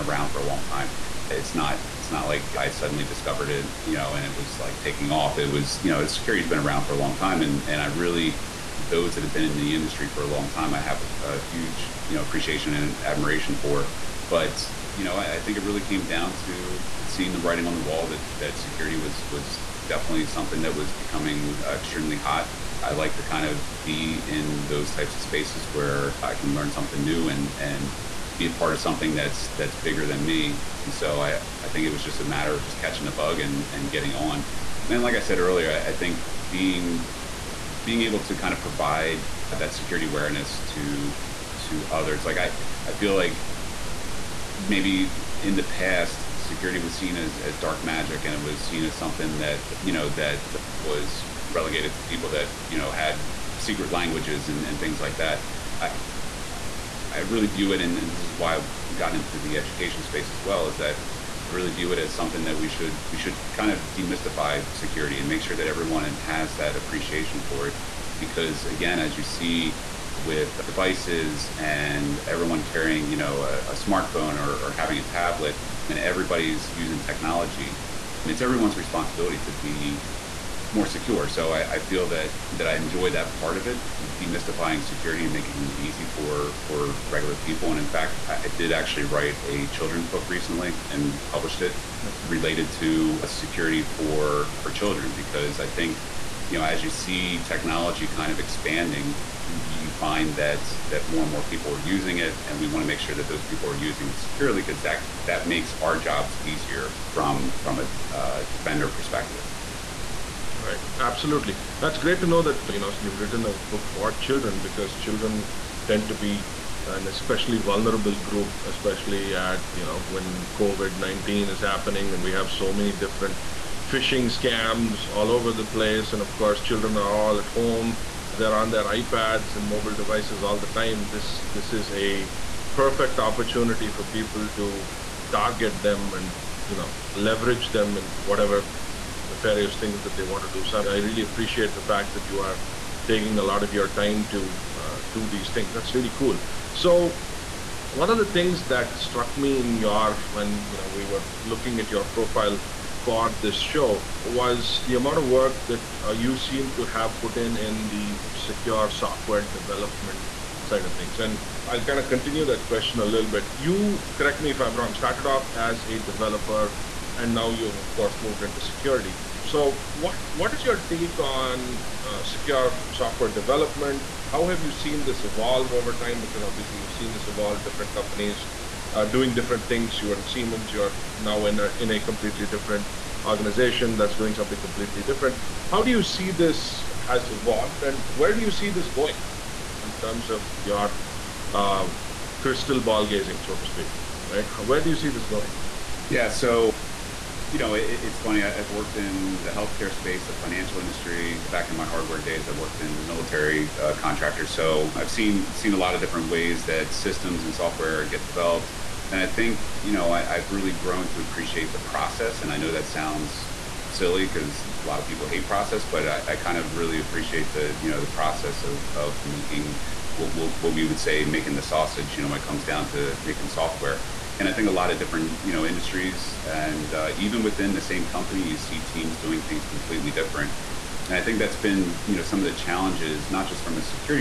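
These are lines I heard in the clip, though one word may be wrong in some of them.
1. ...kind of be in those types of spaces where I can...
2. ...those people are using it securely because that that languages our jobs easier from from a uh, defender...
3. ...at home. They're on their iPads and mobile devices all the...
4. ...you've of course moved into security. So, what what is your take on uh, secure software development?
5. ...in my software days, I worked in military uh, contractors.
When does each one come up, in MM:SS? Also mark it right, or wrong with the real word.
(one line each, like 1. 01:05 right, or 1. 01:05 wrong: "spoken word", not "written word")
1. 00:23 right
2. 01:43 wrong: "makes", not "languages"
3. 02:07 right
4. 02:47 right
5. 03:21 wrong: "hardware", not "software".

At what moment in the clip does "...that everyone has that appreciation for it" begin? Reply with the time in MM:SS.
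01:05.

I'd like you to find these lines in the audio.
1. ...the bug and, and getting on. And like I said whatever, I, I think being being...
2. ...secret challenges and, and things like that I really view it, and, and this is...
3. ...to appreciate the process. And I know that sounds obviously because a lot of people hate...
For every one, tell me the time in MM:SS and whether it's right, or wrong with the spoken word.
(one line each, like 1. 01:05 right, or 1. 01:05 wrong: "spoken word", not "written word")
1. 00:33 wrong: "earlier", not "whatever"
2. 00:53 wrong: "languages", not "challenges"
3. 03:31 wrong: "silly", not "obviously".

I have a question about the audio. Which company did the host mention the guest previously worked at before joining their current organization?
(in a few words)
Siemens.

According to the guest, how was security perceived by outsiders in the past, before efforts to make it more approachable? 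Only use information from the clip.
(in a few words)
dark magic.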